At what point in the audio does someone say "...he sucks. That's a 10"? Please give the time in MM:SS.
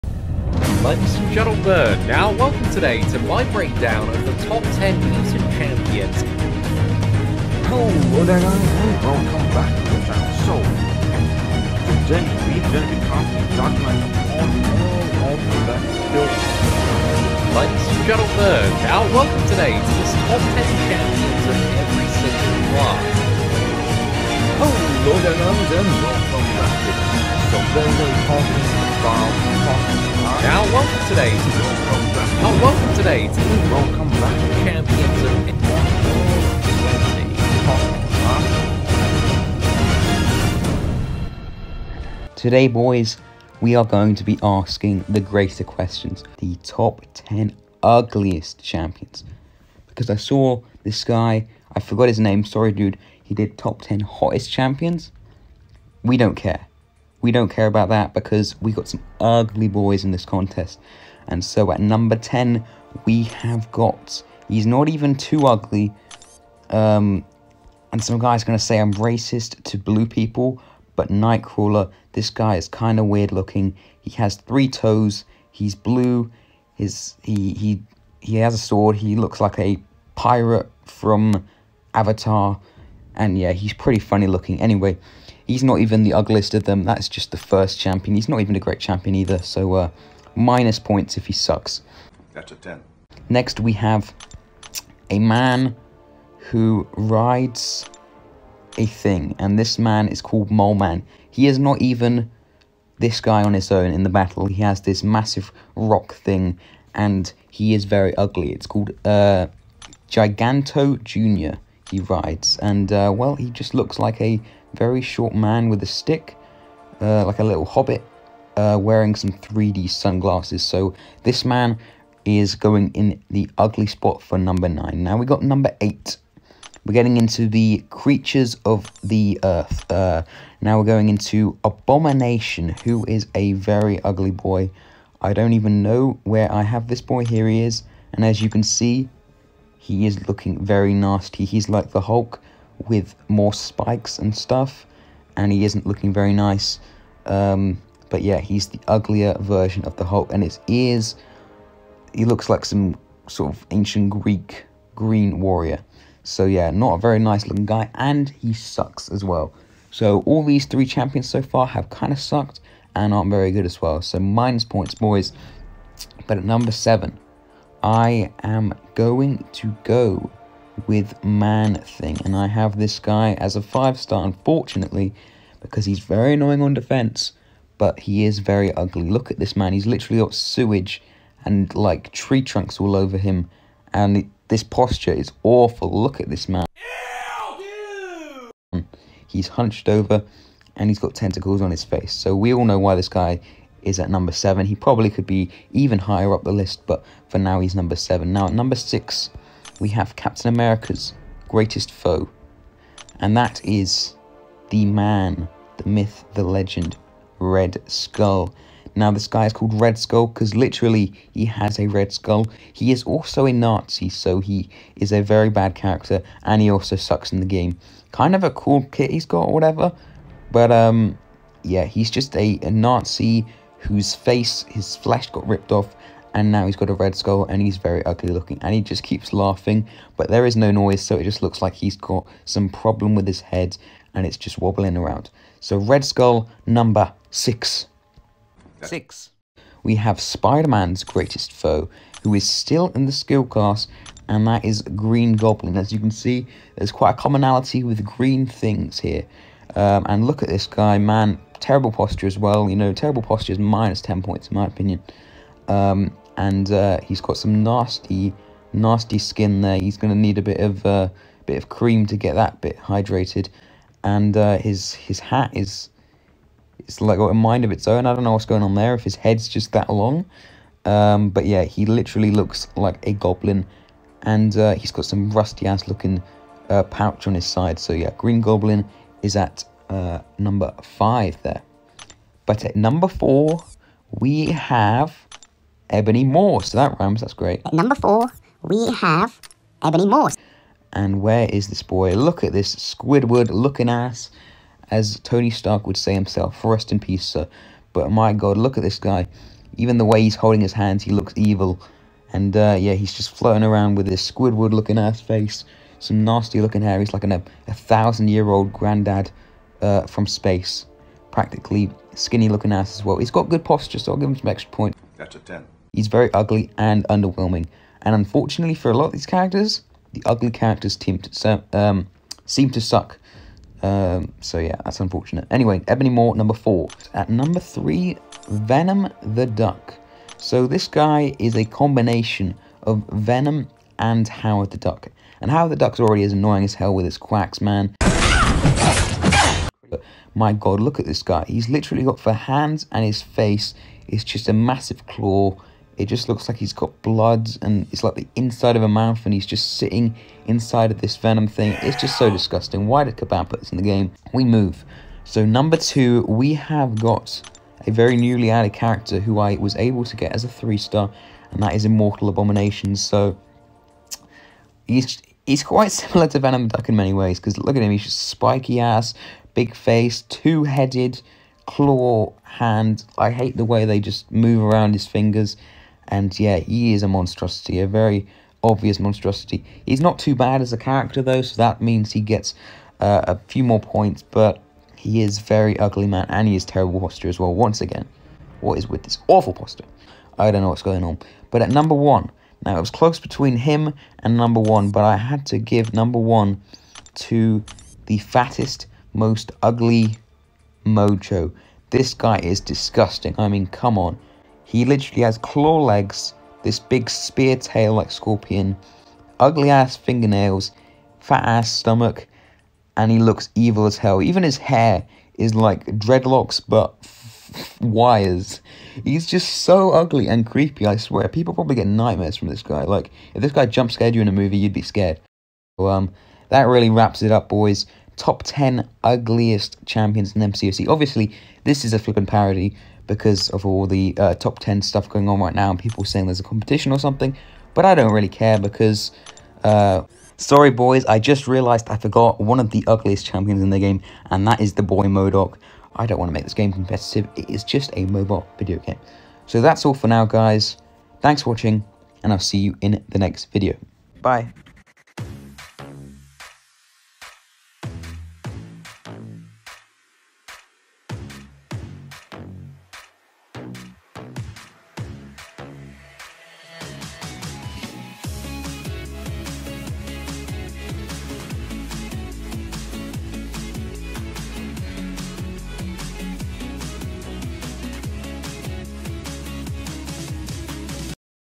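01:31.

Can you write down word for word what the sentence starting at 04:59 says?
Even the way he's holding his hands, he looks evil.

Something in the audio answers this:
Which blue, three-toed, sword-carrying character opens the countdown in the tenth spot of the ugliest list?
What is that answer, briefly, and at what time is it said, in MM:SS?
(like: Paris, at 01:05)
Nightcrawler, at 01:11.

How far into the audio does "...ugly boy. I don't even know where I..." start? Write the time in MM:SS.
02:14.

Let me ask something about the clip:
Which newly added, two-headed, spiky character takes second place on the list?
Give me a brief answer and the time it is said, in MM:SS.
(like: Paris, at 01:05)
Immortal Abomination, at 06:01.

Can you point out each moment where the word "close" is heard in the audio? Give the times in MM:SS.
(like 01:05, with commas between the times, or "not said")
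06:32.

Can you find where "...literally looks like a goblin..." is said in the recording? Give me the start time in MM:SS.
04:31.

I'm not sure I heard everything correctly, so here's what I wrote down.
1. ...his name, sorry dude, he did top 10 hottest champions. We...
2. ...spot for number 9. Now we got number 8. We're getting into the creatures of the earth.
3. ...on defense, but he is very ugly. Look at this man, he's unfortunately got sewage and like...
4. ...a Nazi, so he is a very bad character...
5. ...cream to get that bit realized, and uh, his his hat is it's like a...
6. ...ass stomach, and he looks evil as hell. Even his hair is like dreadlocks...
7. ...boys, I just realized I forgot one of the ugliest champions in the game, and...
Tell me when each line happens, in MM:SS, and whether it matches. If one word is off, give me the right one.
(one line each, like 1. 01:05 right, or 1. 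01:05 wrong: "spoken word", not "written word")
1. 00:52 right
2. 02:03 right
3. 02:56 wrong: "literally", not "unfortunately"
4. 03:33 right
5. 04:21 wrong: "hydrated", not "realized"
6. 06:51 right
7. 07:20 right.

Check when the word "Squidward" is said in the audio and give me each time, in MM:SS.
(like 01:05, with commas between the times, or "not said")
04:52, 05:04.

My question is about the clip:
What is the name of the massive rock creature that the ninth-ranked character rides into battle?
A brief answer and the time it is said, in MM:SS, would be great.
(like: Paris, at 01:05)
Giganto Jr., at 01:50.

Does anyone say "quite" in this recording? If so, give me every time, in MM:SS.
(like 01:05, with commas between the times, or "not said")
04:06, 06:05.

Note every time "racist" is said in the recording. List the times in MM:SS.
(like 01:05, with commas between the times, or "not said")
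01:08.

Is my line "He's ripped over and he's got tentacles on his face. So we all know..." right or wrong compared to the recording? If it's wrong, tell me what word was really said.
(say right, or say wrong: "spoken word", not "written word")
wrong: "hunched", not "ripped".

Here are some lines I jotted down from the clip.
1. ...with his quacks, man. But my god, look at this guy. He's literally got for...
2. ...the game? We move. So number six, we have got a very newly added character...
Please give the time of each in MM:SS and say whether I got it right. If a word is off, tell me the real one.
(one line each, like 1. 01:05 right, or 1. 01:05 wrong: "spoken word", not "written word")
1. 05:36 right
2. 05:53 wrong: "two", not "six".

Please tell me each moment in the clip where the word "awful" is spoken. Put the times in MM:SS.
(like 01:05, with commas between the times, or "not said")
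03:05, 06:29.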